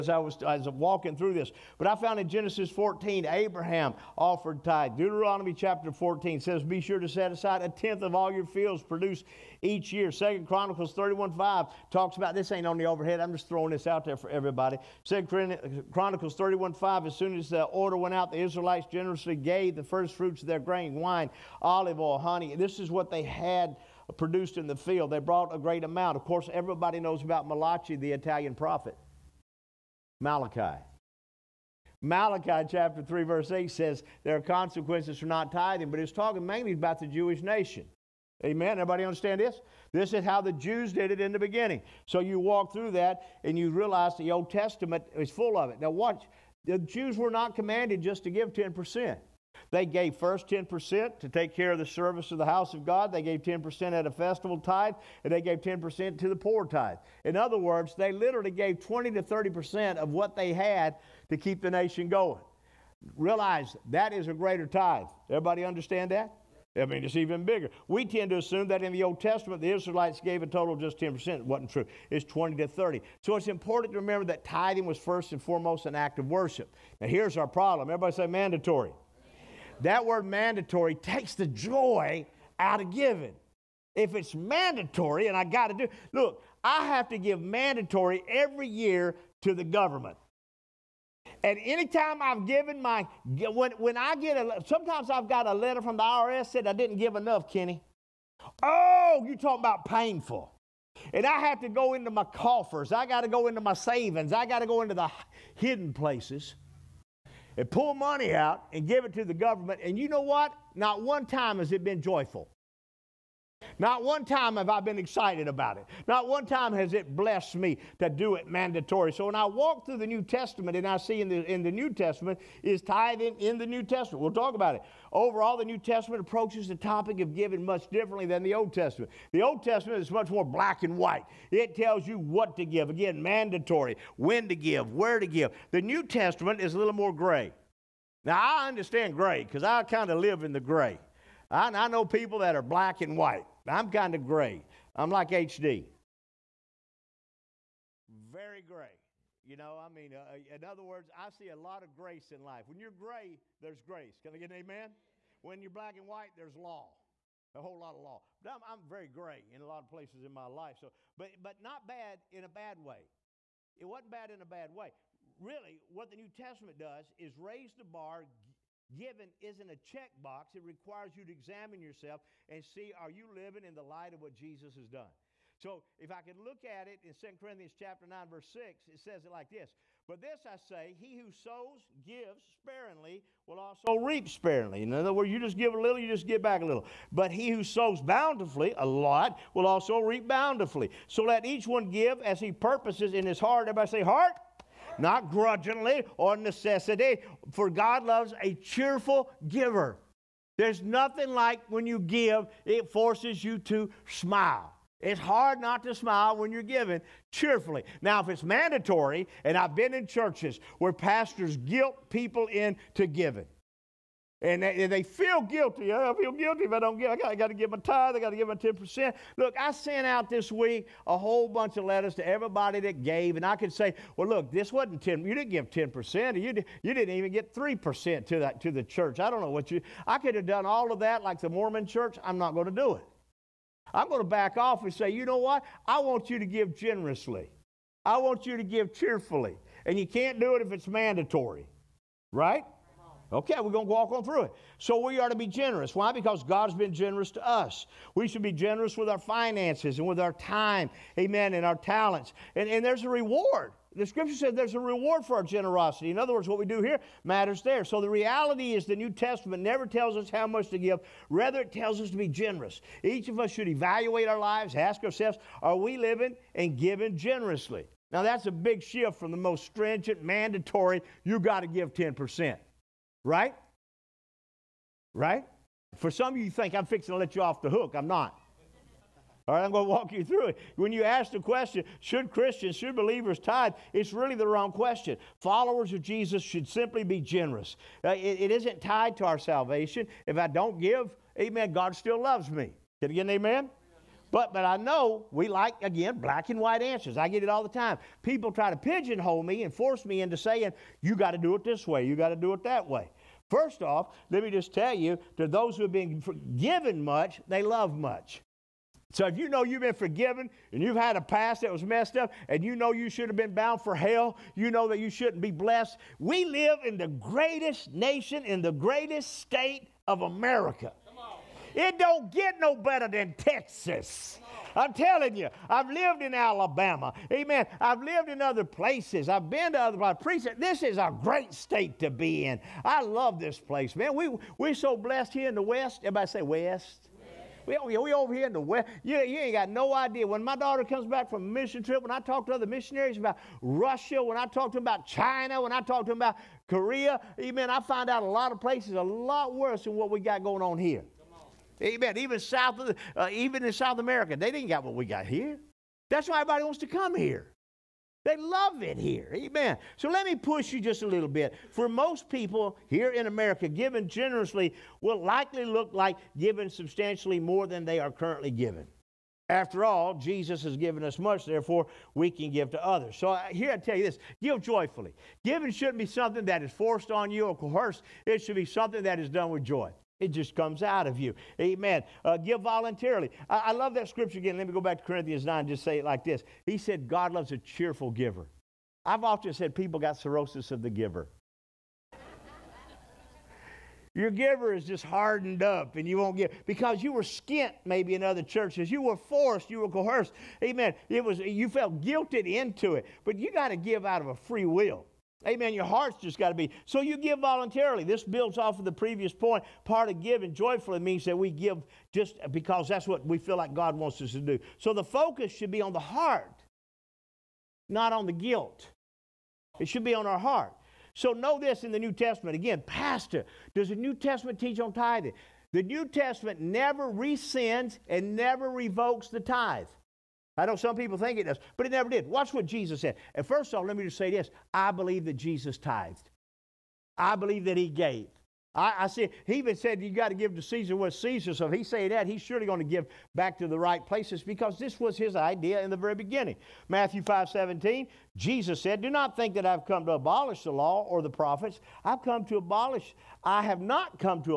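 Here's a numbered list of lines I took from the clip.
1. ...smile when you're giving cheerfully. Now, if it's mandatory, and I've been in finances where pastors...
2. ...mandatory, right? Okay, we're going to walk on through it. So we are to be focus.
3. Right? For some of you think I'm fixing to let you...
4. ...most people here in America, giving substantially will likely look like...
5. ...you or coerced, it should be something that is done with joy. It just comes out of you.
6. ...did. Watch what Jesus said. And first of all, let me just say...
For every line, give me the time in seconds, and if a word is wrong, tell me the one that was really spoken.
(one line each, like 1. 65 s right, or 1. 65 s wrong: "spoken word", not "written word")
1. 205 s wrong: "churches", not "finances"
2. 240 s wrong: "generous", not "focus"
3. 275 s right
4. 361 s wrong: "generously", not "substantially"
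5. 377 s right
6. 432 s right.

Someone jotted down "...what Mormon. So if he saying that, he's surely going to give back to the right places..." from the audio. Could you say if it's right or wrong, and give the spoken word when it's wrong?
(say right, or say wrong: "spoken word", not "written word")
wrong: "Caesar", not "Mormon".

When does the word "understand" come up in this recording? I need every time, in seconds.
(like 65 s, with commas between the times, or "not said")
39 s, 65 s, 138 s.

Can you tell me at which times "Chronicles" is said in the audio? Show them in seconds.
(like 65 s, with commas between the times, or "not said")
10 s, 15 s.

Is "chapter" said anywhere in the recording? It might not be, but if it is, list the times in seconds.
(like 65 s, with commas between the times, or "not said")
5 s, 32 s, 177 s.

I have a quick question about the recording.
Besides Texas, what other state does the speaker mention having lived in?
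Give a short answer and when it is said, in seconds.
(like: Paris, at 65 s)
Alabama, at 326 s.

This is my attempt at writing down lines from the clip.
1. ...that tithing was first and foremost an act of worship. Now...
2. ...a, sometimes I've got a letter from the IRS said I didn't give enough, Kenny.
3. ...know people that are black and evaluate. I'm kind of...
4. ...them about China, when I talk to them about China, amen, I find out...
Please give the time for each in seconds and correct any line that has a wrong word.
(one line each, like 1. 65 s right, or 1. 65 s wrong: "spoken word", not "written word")
1. 74 s right
2. 94 s right
3. 141 s wrong: "white", not "evaluate"
4. 344 s wrong: "Korea", not "China".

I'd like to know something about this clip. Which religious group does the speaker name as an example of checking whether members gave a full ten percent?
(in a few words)
Mormon church.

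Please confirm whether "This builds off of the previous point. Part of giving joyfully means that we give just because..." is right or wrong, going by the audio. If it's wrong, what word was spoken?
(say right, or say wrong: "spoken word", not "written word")
right.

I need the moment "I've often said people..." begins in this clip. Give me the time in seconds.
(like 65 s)
389 s.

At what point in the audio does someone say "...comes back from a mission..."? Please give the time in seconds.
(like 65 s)
340 s.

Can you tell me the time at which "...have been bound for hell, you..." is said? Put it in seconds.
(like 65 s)
313 s.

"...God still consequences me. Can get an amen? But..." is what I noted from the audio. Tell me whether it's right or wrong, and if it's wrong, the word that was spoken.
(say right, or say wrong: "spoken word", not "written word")
wrong: "loves", not "consequences".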